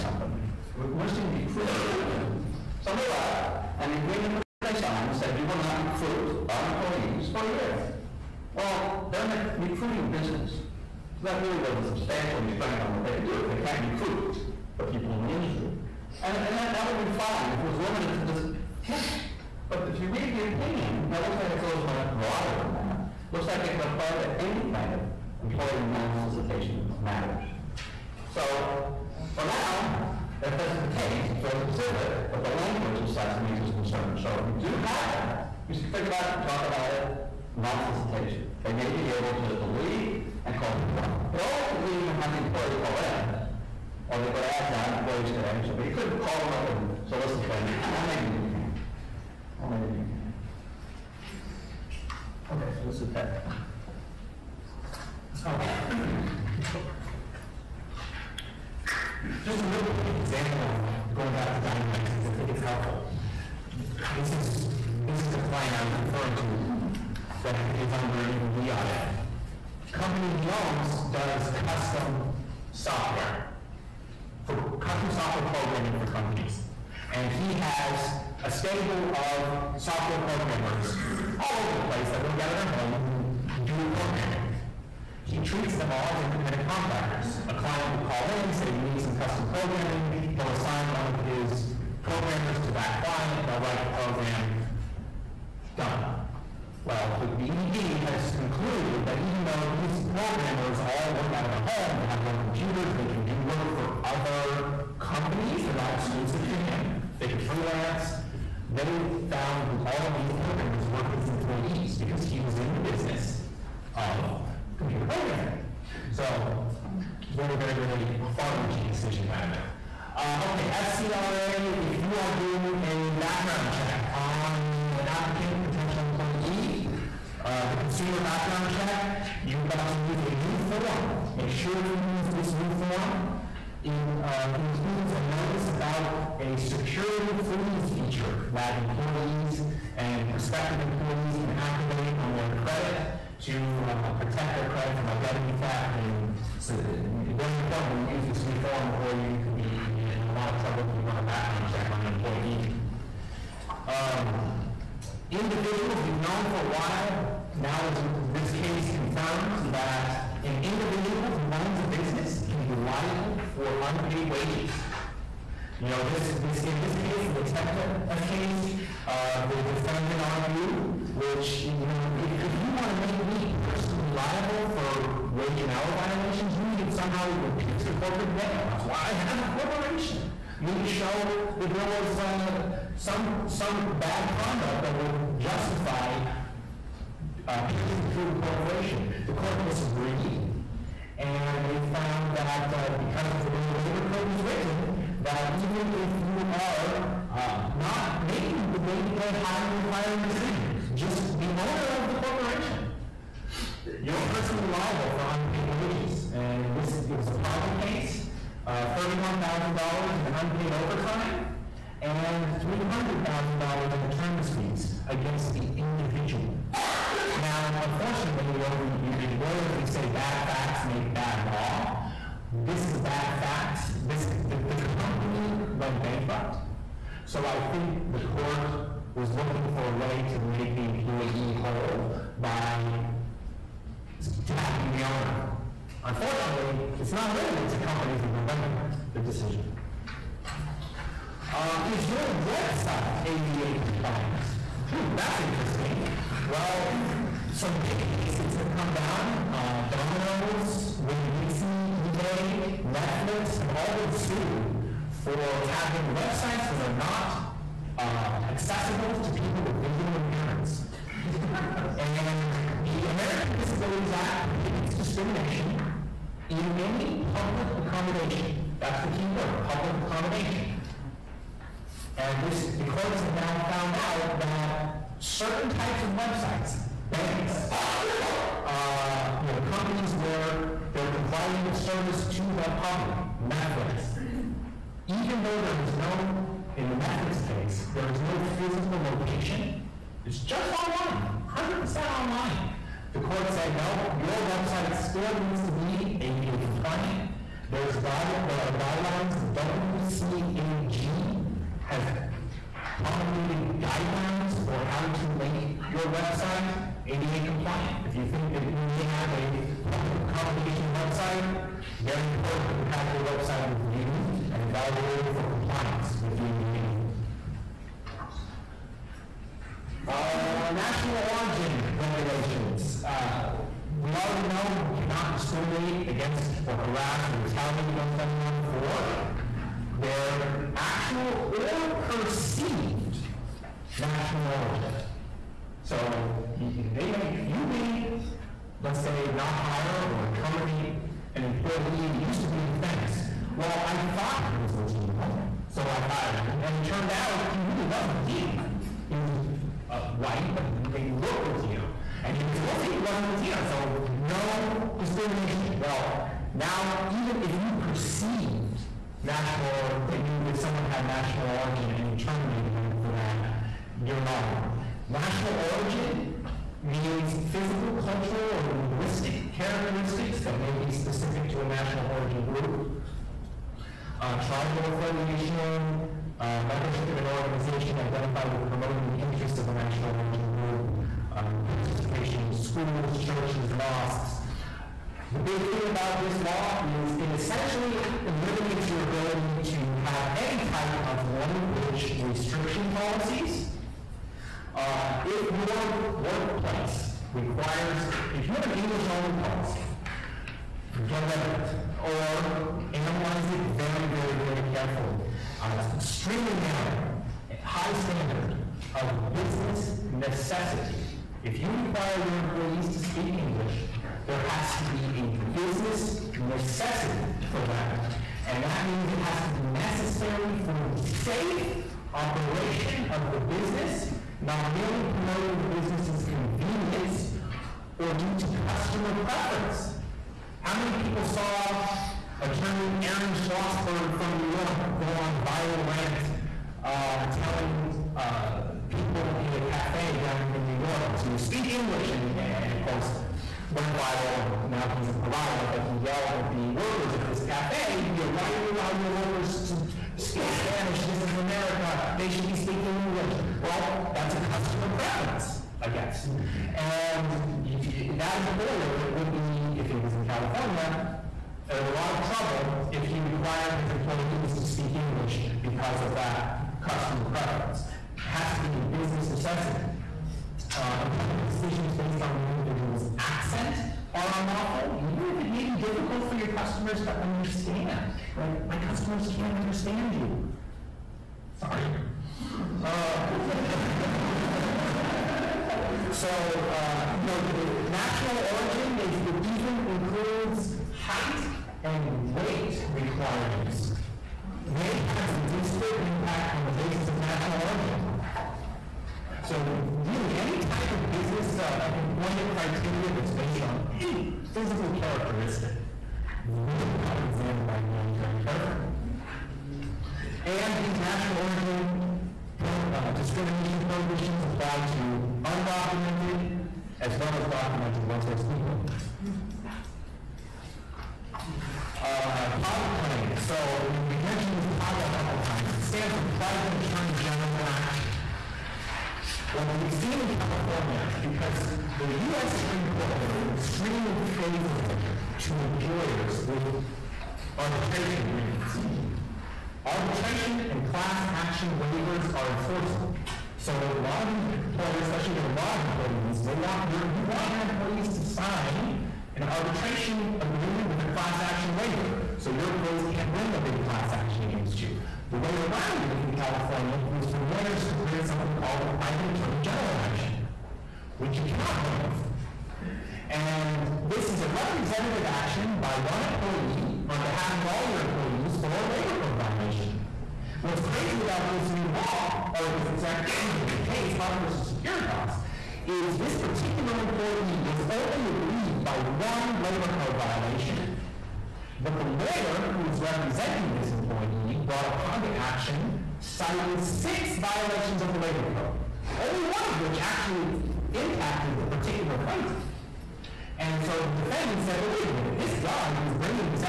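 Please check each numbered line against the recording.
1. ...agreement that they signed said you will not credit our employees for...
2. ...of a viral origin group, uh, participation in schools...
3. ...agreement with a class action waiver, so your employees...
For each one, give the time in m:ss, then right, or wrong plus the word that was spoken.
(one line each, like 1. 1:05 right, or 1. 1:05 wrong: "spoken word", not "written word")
1. 0:03 wrong: "recruit", not "credit"
2. 6:19 wrong: "national", not "viral"
3. 9:10 right.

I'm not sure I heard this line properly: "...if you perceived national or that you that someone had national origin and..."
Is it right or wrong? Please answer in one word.
right.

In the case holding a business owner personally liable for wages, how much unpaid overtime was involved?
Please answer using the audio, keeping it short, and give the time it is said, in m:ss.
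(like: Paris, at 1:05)
$31,000, at 3:28.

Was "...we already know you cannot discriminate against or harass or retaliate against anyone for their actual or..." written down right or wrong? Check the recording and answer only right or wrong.
right.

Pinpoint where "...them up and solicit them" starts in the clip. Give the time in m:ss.
0:46.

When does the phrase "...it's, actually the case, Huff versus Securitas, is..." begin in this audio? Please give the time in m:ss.
9:32.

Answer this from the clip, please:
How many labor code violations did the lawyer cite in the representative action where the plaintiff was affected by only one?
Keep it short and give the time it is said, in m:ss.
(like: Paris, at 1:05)
6, at 9:46.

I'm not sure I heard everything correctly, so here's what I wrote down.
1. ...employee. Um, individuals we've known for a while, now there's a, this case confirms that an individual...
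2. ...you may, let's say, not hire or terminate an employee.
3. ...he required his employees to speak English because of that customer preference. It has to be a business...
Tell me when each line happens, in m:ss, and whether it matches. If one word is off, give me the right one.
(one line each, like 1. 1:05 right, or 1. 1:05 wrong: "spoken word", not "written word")
1. 2:32 right
2. 5:37 right
3. 7:43 right.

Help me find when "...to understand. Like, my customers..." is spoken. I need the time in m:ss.
7:57.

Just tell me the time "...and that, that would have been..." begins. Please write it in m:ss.
0:16.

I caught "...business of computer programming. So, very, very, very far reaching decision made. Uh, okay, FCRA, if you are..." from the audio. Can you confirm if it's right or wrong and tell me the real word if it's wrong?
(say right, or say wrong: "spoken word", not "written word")
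right.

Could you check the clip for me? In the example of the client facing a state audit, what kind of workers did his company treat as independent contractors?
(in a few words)
Software programmers.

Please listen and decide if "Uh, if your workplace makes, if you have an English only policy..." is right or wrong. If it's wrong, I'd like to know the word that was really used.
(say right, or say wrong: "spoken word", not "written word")
wrong: "requires", not "makes".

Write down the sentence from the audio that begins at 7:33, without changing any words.
Well, that's a customer preference, I guess.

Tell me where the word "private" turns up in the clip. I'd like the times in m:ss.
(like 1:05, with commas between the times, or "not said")
8:46, 9:18.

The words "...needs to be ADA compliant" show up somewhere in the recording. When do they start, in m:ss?
4:55.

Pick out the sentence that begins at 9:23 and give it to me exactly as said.
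And this is a representative action by one employee on behalf of all your employees for a labor code violation.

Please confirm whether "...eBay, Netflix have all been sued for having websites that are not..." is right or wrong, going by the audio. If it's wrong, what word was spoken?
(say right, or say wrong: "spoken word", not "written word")
right.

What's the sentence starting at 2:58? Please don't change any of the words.
That's why I have a corporation.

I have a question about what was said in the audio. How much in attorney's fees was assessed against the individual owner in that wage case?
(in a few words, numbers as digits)
$300,000.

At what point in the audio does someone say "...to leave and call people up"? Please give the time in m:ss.
0:39.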